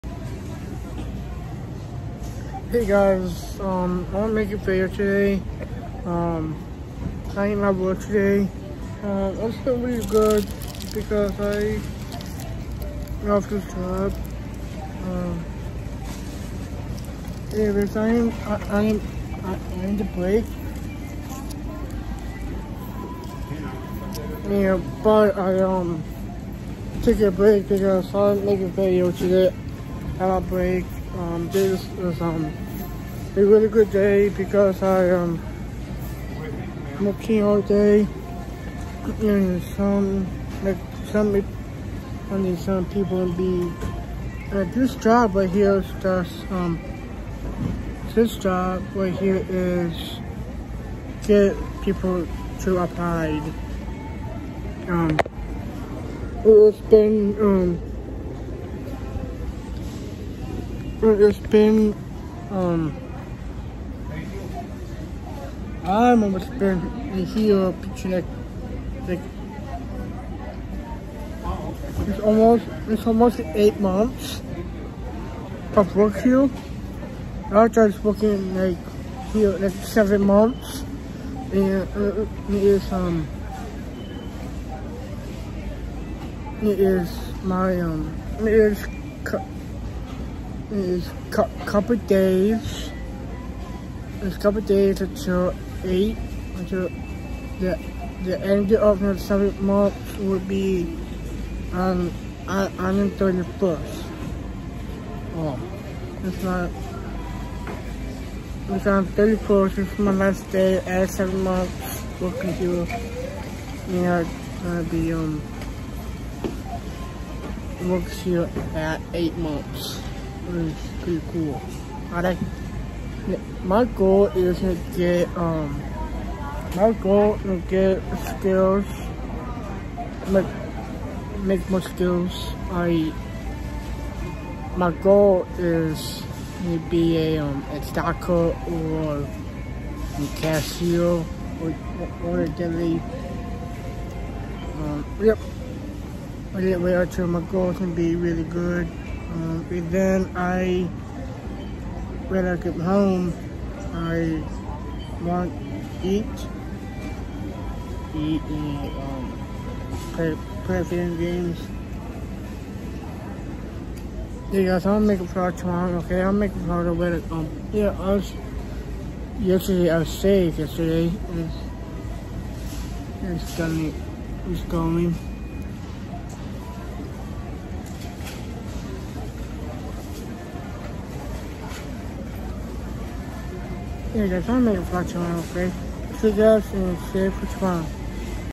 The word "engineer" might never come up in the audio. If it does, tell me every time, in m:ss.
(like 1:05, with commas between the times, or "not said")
not said.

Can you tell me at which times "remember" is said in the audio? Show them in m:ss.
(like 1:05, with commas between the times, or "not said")
1:06.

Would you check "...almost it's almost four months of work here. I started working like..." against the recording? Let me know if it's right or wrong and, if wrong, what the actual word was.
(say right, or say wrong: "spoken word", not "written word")
wrong: "eight", not "four".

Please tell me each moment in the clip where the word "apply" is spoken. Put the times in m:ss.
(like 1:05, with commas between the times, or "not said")
0:52.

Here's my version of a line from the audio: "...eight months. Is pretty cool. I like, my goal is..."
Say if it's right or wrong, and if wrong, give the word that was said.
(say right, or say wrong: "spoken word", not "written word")
right.